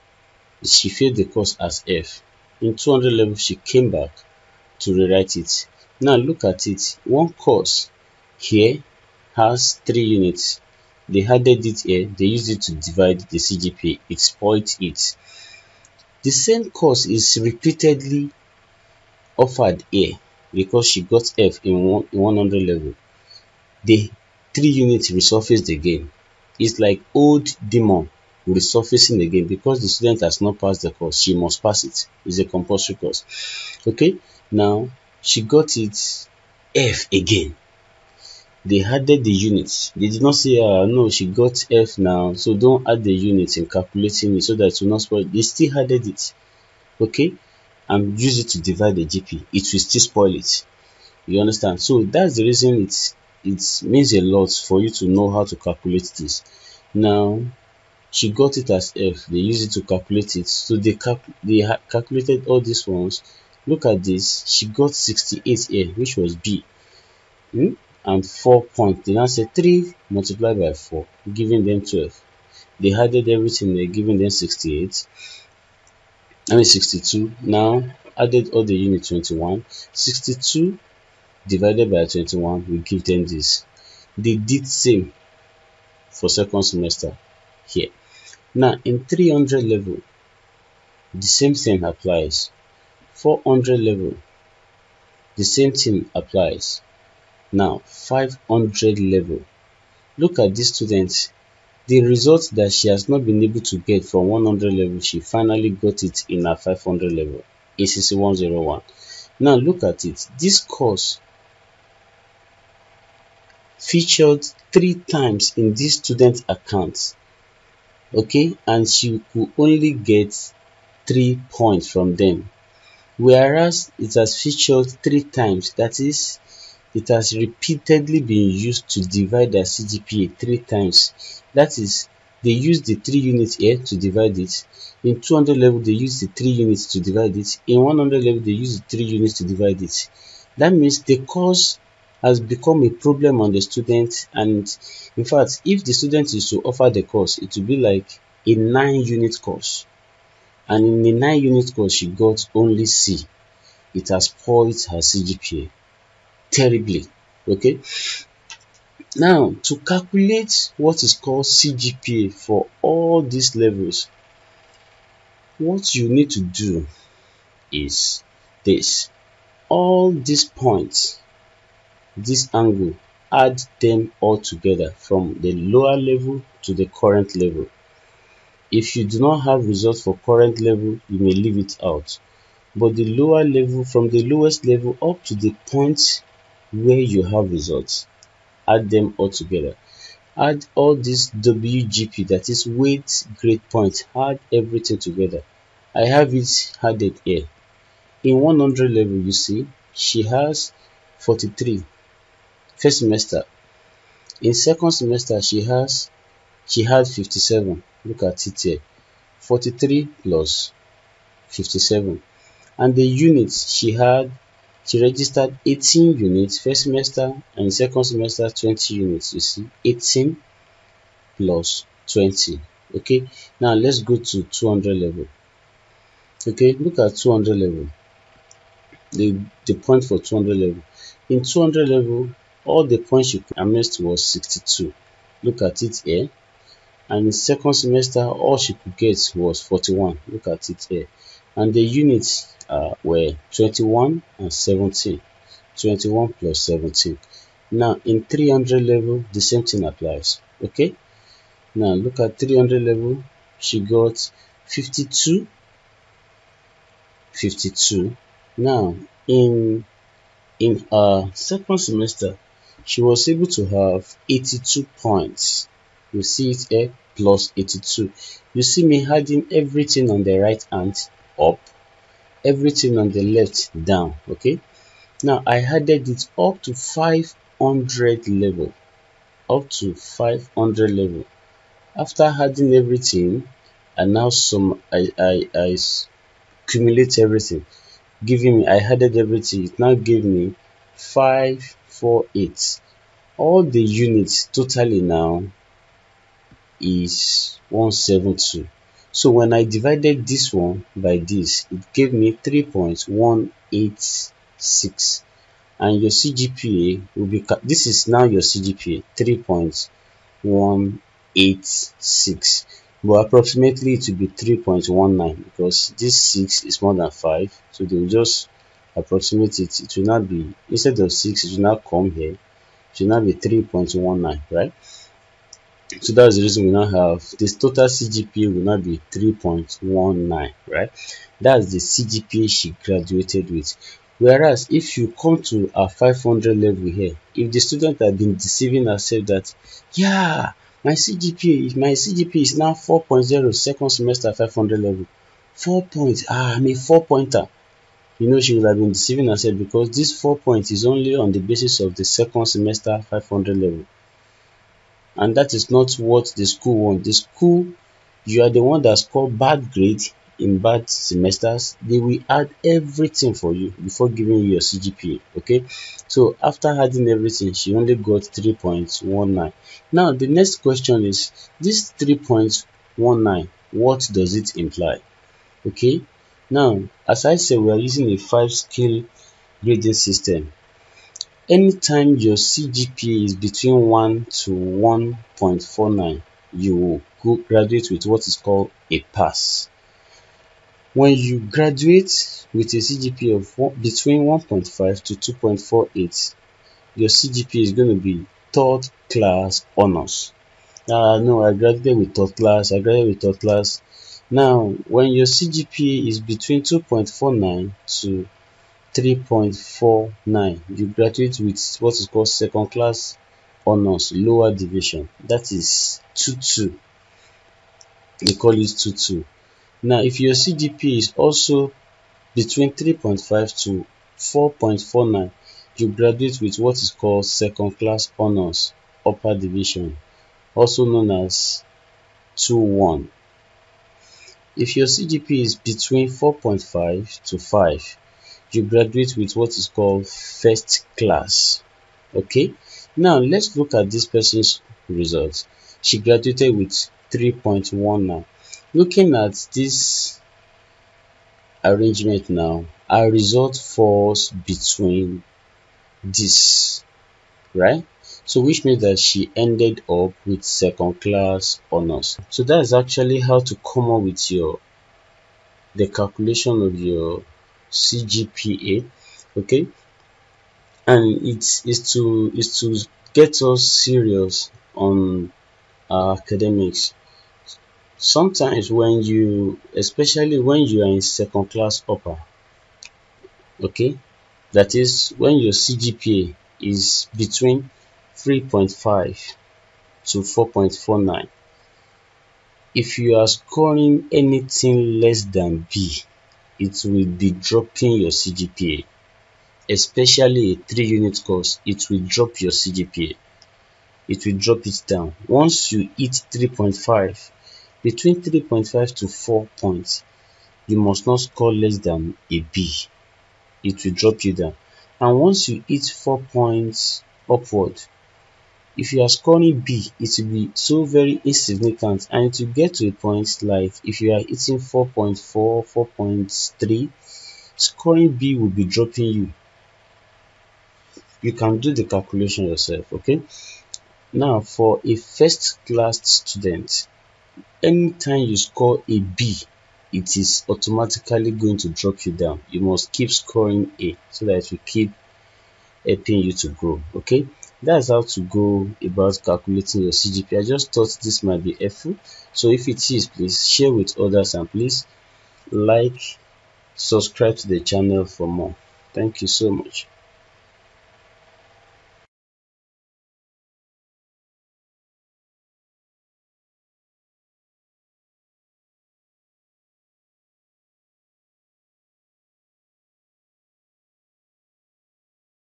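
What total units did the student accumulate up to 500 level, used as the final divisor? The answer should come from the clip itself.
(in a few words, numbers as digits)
172.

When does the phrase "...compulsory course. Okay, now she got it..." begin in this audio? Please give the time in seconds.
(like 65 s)
32 s.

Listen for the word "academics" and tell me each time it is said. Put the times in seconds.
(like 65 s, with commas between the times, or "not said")
475 s.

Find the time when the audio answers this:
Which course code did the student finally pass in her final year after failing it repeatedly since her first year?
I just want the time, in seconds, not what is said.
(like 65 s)
107 s.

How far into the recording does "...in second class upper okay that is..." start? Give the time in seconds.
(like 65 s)
480 s.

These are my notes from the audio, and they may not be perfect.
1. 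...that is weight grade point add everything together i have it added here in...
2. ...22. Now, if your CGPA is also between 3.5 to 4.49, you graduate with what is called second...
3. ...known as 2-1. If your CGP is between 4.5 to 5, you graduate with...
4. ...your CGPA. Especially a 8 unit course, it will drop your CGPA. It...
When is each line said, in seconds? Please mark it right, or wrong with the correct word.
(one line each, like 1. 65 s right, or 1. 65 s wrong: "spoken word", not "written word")
1. 192 s right
2. 418 s right
3. 430 s right
4. 498 s wrong: "3", not "8".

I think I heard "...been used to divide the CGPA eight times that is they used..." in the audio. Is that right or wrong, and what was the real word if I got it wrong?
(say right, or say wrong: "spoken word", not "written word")
wrong: "three", not "eight".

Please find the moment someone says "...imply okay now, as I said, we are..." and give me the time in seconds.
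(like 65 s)
374 s.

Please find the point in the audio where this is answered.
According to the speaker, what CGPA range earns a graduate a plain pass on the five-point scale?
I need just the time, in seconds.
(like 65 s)
383 s.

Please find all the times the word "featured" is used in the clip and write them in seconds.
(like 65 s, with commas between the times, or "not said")
113 s, 124 s.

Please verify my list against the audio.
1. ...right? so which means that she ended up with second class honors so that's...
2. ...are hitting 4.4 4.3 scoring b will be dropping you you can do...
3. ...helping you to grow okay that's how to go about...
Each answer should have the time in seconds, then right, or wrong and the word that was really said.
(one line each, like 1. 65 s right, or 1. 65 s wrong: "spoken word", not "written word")
1. 457 s right
2. 524 s right
3. 545 s right.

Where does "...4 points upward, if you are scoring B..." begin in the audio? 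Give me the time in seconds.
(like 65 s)
515 s.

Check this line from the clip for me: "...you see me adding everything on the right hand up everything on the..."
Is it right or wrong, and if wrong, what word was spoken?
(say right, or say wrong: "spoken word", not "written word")
right.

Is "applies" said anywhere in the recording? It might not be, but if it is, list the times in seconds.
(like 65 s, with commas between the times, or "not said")
91 s, 96 s, 249 s.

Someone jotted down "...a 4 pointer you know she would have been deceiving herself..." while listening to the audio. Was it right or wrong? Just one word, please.
right.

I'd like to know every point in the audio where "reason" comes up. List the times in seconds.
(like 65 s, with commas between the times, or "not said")
52 s, 326 s.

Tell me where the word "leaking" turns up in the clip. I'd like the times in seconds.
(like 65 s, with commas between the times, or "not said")
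not said.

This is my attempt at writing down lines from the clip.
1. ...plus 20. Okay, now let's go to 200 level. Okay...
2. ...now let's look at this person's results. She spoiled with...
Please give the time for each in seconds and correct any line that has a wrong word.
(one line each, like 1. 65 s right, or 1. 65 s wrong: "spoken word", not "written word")
1. 221 s right
2. 442 s wrong: "graduated", not "spoiled".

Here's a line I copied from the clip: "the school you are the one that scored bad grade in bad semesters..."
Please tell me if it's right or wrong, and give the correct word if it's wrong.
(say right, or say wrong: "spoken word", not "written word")
right.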